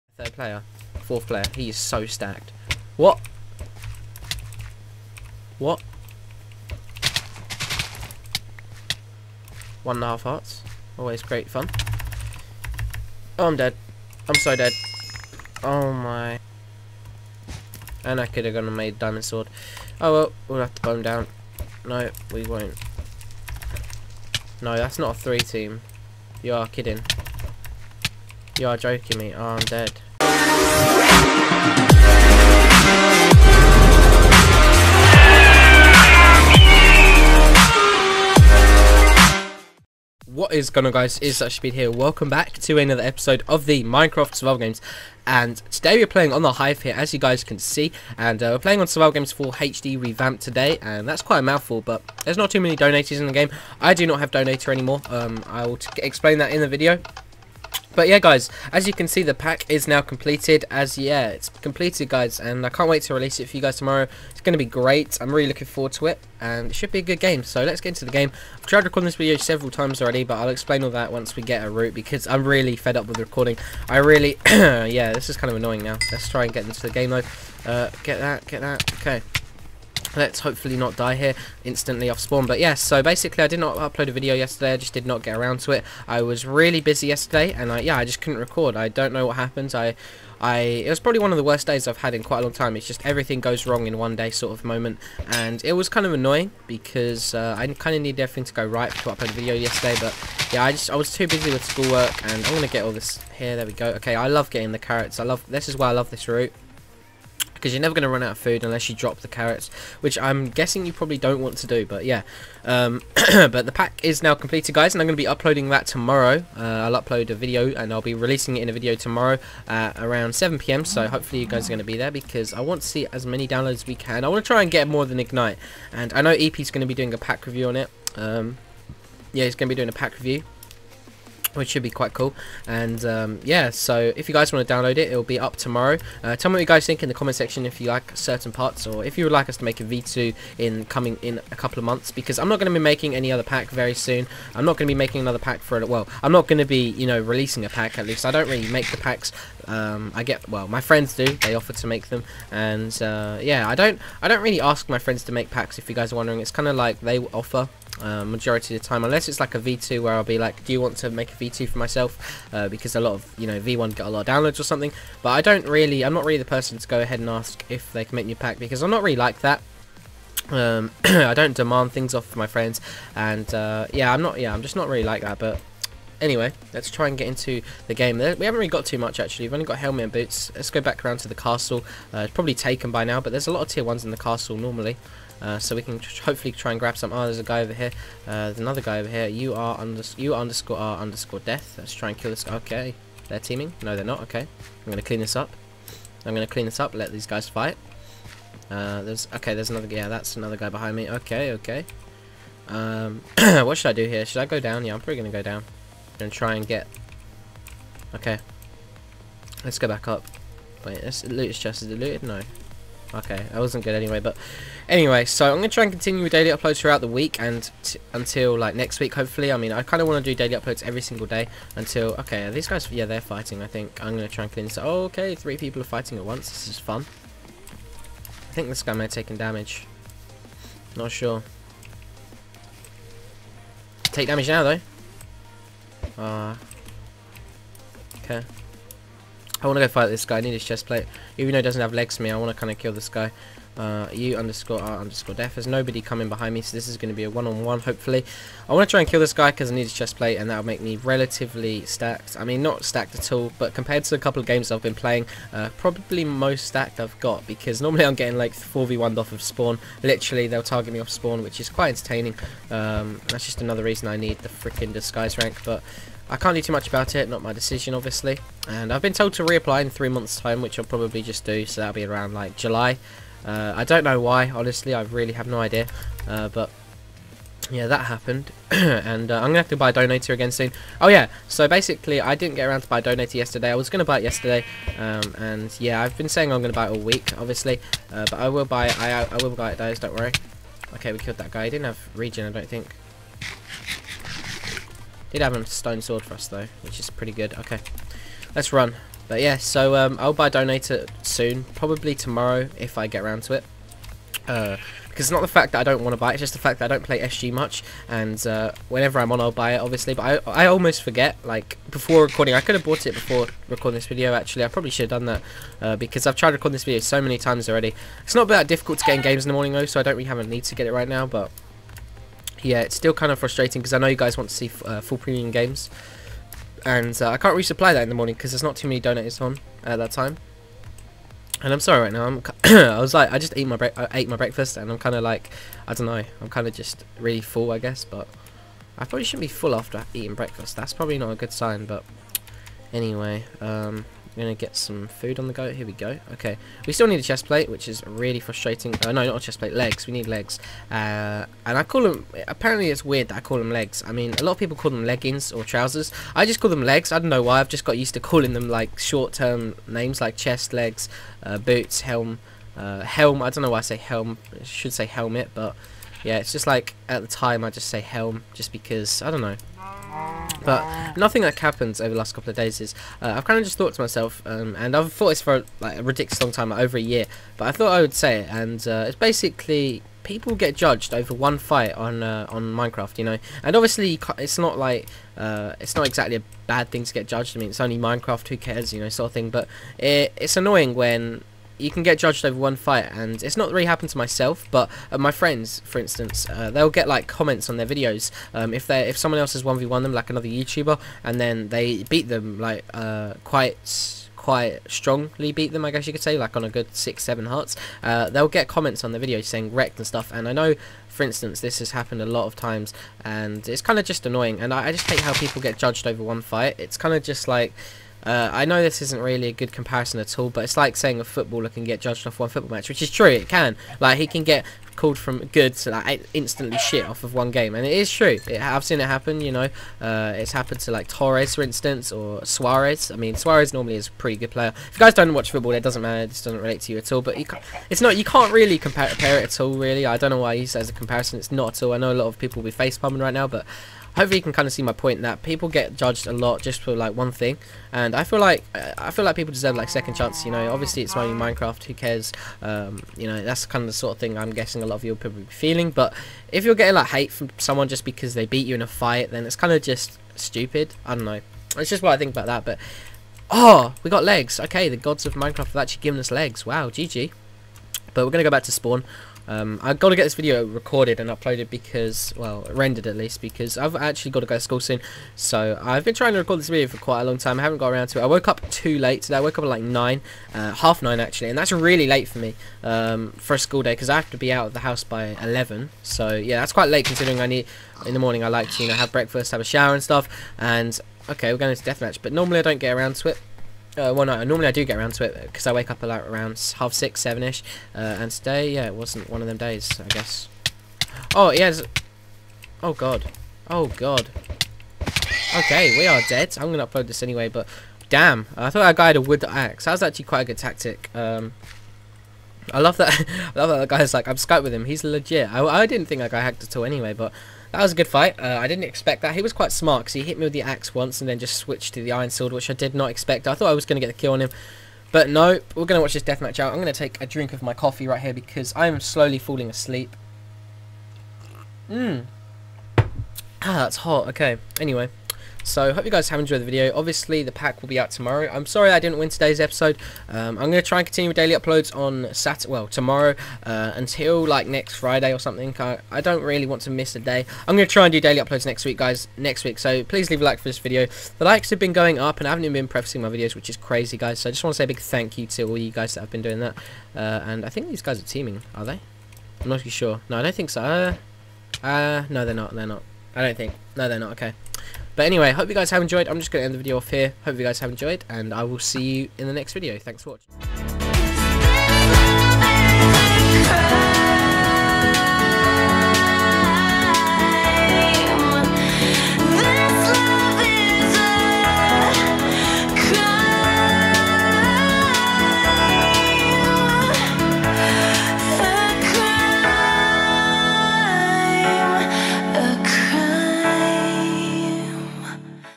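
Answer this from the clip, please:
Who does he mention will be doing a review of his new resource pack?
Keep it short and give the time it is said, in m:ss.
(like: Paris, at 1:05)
EP, at 2:06.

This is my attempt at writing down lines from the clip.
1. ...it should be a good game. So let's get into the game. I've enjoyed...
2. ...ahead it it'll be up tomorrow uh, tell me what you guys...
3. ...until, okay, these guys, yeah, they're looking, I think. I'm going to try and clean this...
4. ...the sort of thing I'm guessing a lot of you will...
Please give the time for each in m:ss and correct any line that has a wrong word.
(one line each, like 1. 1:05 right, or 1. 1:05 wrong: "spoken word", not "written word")
1. 1:06 wrong: "tried", not "enjoyed"
2. 2:14 wrong: "download", not "ahead"
3. 3:41 wrong: "fighting", not "looking"
4. 7:33 right.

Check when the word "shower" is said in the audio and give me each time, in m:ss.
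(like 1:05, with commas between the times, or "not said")
8:09.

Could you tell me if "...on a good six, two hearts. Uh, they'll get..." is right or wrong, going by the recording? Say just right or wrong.
wrong.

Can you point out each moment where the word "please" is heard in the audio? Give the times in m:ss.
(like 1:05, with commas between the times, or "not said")
9:10.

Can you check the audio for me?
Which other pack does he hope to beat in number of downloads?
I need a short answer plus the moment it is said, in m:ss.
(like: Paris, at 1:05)
Ignite, at 2:05.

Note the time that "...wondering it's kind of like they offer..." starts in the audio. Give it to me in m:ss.
2:36.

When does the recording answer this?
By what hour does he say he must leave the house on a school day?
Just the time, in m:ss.
8:05.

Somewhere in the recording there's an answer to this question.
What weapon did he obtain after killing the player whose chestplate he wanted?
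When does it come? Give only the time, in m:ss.
4:55.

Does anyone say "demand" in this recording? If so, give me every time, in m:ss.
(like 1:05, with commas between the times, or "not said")
2:51.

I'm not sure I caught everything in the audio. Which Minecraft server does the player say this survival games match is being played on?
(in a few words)
The Hive.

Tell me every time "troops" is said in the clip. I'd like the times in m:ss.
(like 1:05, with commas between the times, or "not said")
not said.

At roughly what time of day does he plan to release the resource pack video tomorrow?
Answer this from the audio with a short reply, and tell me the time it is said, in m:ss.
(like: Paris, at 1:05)
7pm, at 2:00.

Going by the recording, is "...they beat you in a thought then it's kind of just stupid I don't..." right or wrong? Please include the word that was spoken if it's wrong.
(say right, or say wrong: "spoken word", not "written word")
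wrong: "fight", not "thought".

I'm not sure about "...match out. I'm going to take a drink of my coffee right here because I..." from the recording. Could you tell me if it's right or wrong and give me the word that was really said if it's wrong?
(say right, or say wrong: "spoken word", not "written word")
wrong: "deathmatch", not "match".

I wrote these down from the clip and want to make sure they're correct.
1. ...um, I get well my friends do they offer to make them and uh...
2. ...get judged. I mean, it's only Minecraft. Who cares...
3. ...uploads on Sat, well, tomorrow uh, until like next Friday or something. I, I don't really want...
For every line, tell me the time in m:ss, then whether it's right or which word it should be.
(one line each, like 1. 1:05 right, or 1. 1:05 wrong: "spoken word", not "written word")
1. 2:29 right
2. 6:27 right
3. 9:01 right.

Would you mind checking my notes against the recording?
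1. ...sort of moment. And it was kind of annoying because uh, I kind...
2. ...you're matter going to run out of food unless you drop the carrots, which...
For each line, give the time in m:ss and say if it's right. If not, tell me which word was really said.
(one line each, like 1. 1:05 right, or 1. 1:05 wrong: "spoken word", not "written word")
1. 1:34 right
2. 1:47 wrong: "never", not "matter".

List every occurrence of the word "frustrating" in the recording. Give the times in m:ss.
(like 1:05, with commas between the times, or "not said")
5:23, 5:48.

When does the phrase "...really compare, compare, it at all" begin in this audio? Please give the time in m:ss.
7:18.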